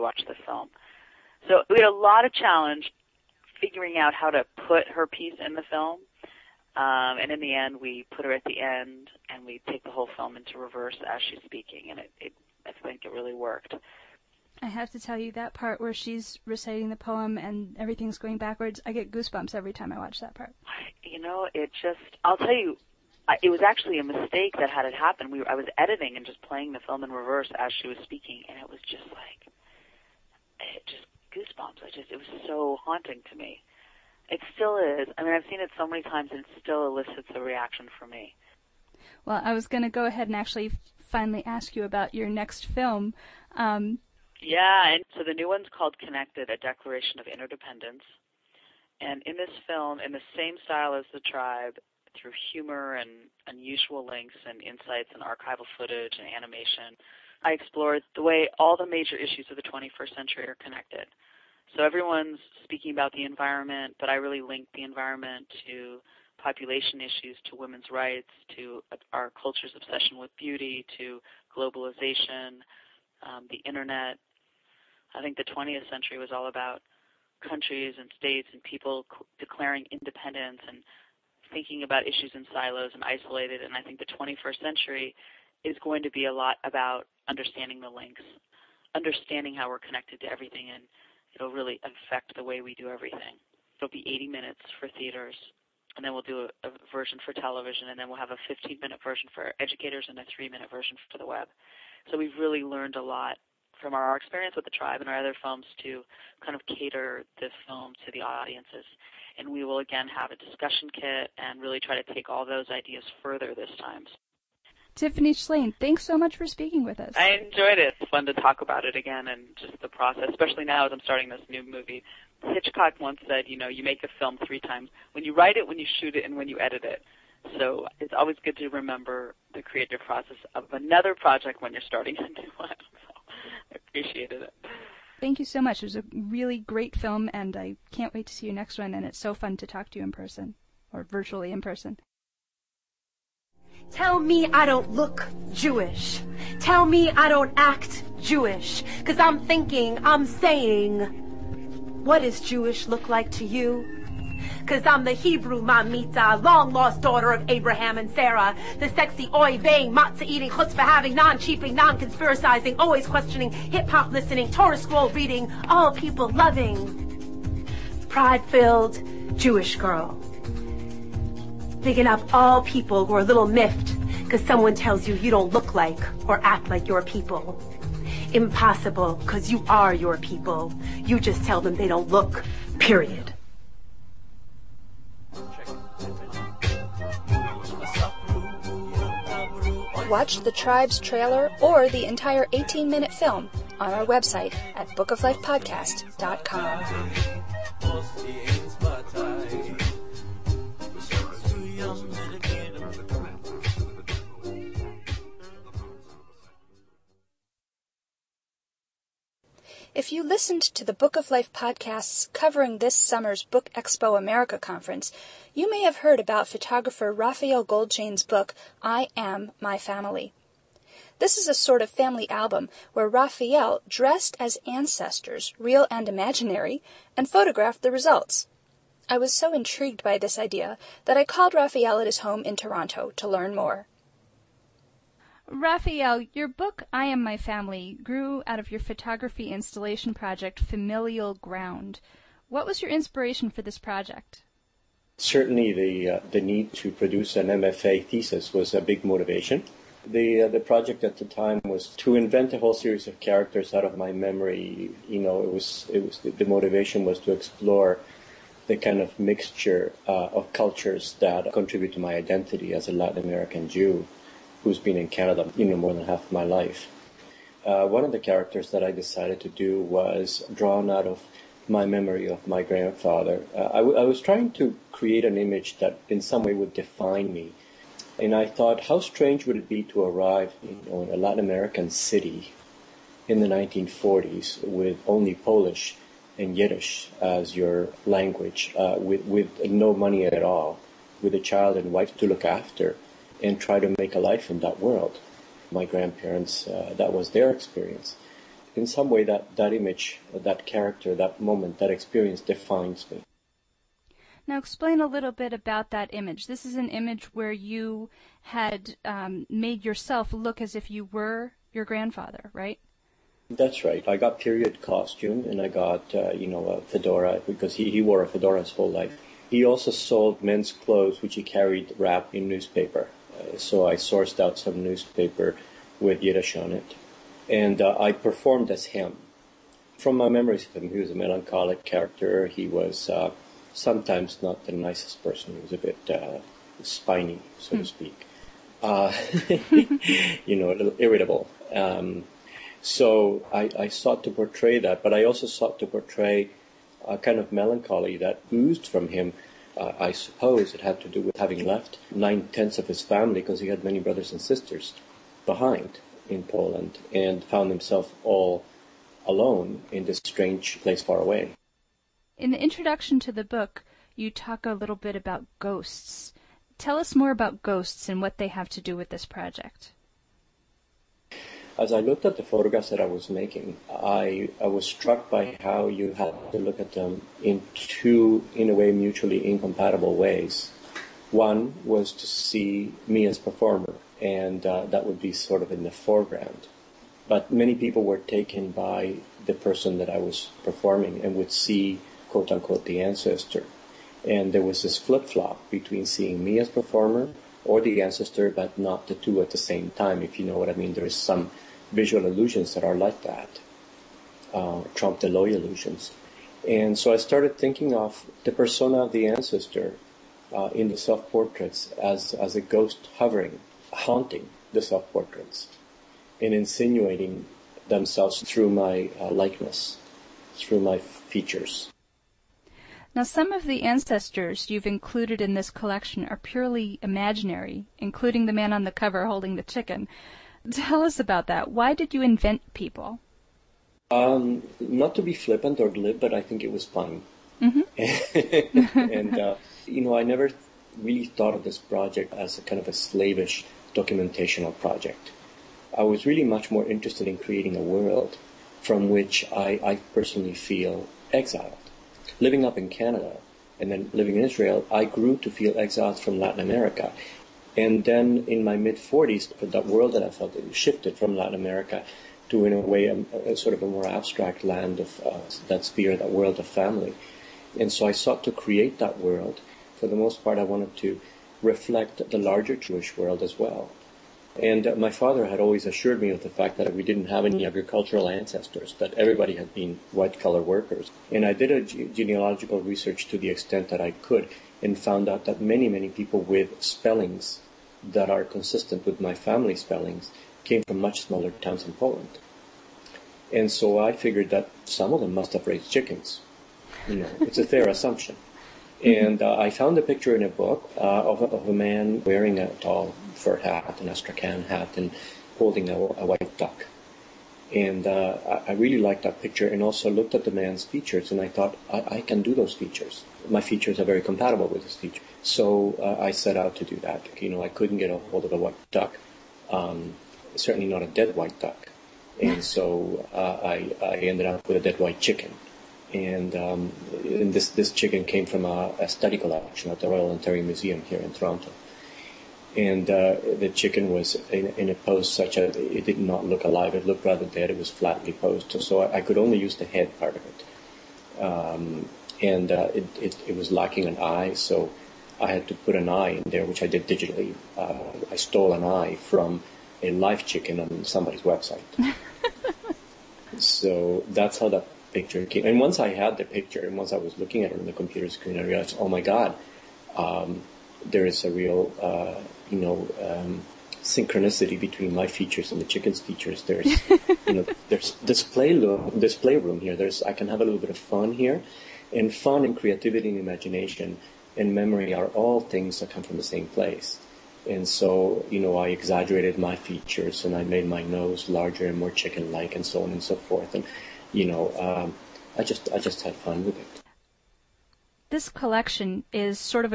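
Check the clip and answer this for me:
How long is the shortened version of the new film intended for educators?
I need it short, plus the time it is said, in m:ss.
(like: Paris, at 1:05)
15 minutes, at 1:38.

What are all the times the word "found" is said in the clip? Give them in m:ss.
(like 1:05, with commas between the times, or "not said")
5:57, 8:04, 8:19.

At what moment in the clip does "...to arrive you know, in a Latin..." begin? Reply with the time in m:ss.
4:39.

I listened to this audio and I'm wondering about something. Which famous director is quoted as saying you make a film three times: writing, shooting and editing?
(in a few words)
Hitchcock.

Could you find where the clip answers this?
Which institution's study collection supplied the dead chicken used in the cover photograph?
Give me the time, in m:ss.
8:50.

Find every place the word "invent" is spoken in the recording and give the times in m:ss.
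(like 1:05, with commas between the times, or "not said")
4:12, 7:12.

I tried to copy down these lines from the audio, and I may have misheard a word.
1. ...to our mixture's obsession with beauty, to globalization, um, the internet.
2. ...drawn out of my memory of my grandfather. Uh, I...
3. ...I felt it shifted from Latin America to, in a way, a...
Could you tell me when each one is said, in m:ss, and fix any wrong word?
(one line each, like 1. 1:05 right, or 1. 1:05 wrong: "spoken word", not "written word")
1. 1:08 wrong: "culture", not "mixture"
2. 4:30 right
3. 7:40 right.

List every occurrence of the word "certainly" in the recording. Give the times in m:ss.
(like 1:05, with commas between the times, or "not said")
4:05, 8:40.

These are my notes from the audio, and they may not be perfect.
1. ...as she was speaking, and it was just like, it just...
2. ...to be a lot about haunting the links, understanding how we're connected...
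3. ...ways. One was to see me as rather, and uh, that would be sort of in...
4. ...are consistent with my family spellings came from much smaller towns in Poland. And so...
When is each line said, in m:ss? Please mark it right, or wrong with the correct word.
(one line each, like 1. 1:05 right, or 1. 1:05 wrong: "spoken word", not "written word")
1. 0:27 right
2. 1:26 wrong: "understanding", not "haunting"
3. 6:20 wrong: "performer", not "rather"
4. 8:08 right.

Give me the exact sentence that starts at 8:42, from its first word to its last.
And so uh, I, I ended up with a dead white chicken.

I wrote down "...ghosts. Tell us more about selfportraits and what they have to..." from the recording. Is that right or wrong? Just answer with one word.
wrong.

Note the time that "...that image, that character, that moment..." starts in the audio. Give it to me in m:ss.
4:59.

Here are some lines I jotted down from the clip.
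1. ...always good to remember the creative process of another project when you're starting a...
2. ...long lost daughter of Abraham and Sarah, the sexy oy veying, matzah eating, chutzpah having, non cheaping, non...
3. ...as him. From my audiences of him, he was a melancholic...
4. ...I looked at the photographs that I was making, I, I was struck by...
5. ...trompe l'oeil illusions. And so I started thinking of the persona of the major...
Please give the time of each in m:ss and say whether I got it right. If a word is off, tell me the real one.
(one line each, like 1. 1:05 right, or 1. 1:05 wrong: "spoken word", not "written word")
1. 2:08 right
2. 2:36 right
3. 5:28 wrong: "memories", not "audiences"
4. 6:11 right
5. 6:44 wrong: "ancestor", not "major".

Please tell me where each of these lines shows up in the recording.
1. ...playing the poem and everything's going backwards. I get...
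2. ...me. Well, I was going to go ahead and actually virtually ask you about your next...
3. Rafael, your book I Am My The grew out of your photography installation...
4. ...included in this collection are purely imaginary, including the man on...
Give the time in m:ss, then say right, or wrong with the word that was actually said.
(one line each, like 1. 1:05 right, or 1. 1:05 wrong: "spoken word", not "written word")
1. 0:16 wrong: "reciting", not "playing"
2. 0:38 wrong: "finally", not "virtually"
3. 3:55 wrong: "Family", not "The"
4. 7:04 right.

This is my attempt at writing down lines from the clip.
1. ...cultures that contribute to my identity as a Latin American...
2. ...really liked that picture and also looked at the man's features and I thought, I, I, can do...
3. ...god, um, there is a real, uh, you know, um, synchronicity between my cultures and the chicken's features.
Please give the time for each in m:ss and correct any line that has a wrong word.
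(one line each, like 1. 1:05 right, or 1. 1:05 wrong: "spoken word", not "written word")
1. 4:20 right
2. 8:28 right
3. 9:19 wrong: "features", not "cultures".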